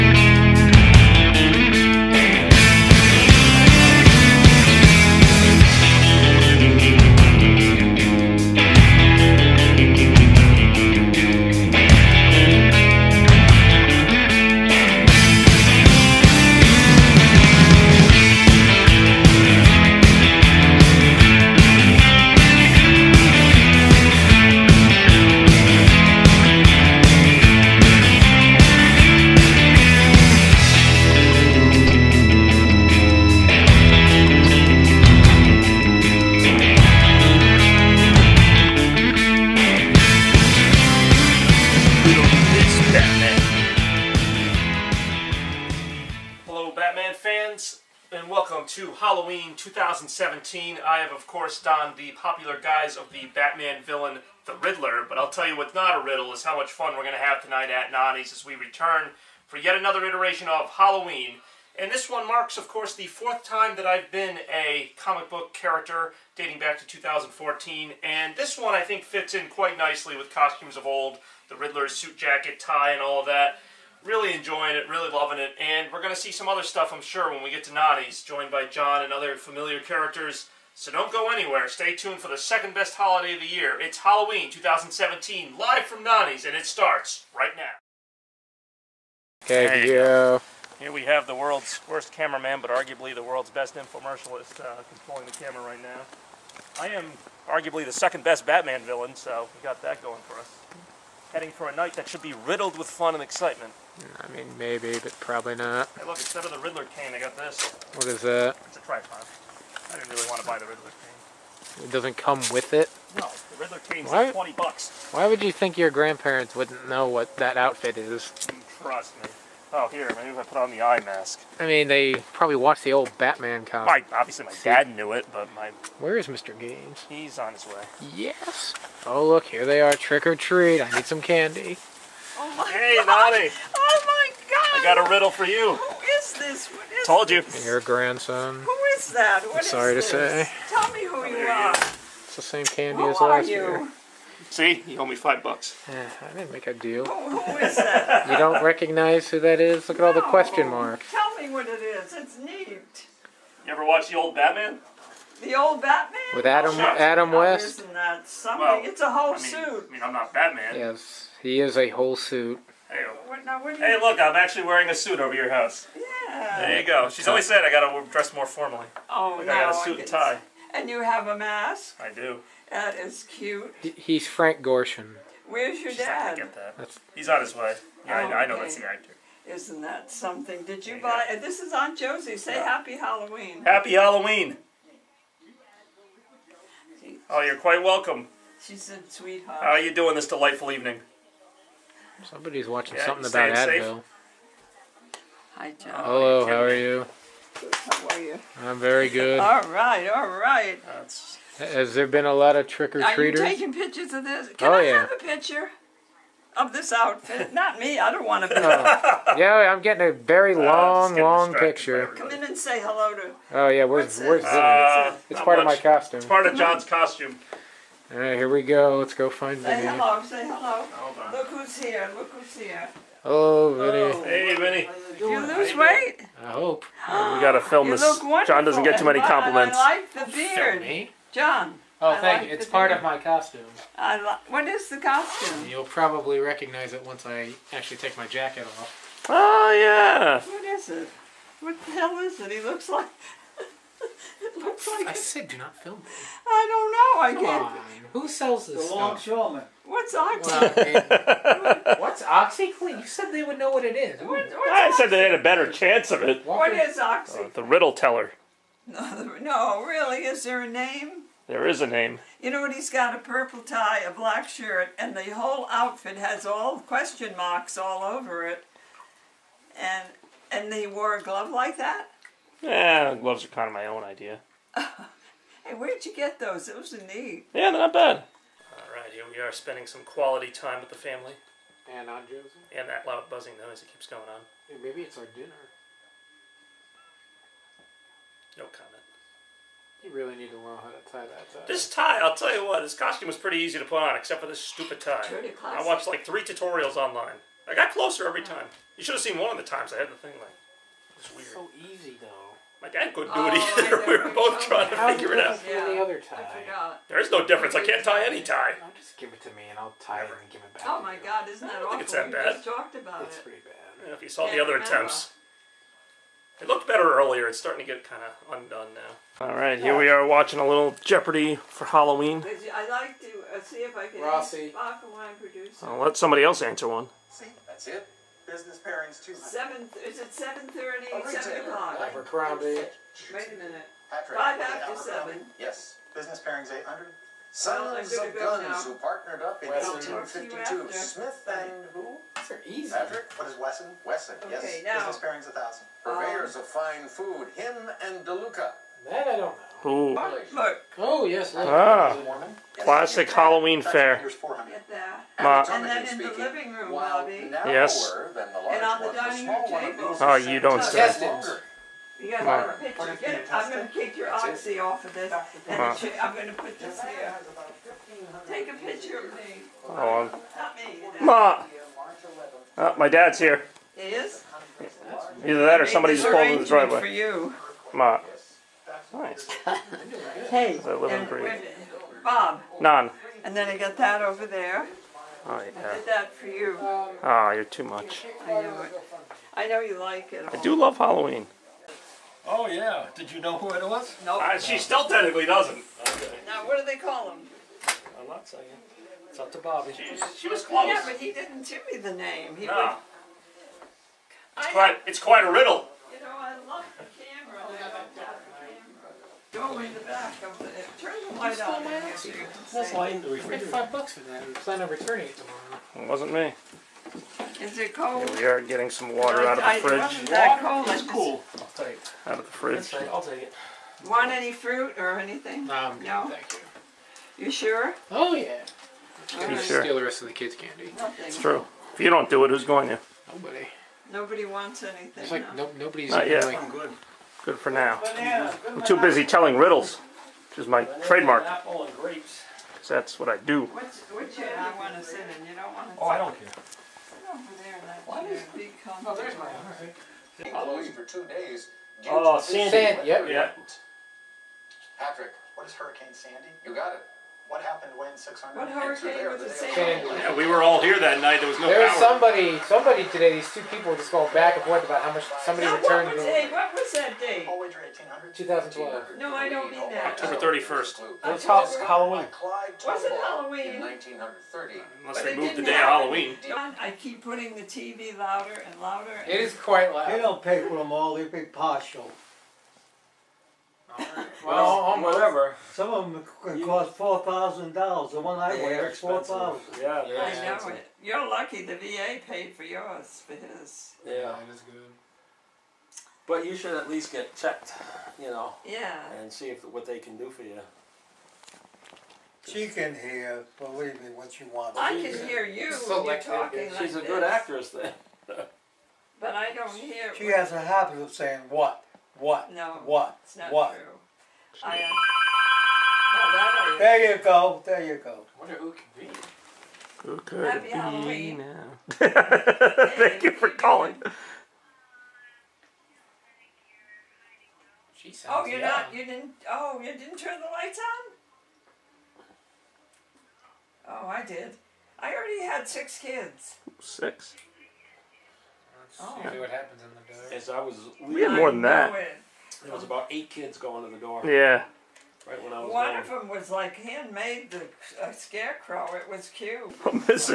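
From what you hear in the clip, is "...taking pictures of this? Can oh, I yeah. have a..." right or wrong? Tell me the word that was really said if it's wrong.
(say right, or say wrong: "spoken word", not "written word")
right.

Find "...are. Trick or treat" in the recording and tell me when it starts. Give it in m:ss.
2:09.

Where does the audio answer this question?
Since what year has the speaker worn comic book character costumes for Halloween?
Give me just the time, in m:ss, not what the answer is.
1:06.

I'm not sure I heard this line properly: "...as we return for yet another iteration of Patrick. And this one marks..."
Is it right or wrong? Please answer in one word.
wrong.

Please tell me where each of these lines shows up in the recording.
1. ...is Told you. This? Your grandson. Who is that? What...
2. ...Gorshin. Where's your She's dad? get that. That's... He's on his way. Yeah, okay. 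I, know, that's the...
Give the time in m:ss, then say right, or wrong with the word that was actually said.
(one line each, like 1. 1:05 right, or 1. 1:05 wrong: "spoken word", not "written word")
1. 2:16 right
2. 2:54 right.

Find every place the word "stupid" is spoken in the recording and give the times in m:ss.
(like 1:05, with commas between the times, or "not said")
4:54.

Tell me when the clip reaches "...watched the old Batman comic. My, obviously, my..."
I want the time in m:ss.
2:02.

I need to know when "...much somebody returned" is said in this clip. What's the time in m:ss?
7:45.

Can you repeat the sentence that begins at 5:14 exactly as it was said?
Yeah, If you saw the other remember.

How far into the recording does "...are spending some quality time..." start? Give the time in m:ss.
4:39.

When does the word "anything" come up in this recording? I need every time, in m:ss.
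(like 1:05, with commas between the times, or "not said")
7:05, 7:14.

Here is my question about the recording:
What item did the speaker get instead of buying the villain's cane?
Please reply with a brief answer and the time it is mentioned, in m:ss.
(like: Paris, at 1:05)
A tripod, at 1:48.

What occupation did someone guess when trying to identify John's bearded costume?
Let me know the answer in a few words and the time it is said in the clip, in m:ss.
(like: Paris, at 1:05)
Longshoreman, at 4:08.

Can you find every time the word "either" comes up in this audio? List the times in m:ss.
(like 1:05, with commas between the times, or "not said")
5:03, 6:15.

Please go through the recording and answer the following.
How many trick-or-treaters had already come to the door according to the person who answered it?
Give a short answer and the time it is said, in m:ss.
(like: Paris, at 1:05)
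6, at 8:55.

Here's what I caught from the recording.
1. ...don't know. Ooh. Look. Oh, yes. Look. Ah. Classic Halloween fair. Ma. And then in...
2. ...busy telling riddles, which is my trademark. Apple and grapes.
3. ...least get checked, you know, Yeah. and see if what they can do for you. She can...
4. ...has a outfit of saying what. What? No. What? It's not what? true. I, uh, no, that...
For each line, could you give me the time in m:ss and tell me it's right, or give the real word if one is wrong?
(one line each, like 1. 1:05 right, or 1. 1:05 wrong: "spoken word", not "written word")
1. 5:49 right
2. 7:18 right
3. 8:16 right
4. 8:30 wrong: "habit", not "outfit".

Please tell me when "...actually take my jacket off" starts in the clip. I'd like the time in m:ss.
3:57.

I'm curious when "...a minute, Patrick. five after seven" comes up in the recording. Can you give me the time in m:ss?
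5:33.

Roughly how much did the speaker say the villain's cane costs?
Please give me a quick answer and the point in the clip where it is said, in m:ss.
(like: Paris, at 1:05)
20 bucks, at 1:54.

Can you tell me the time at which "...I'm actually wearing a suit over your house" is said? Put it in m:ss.
2:44.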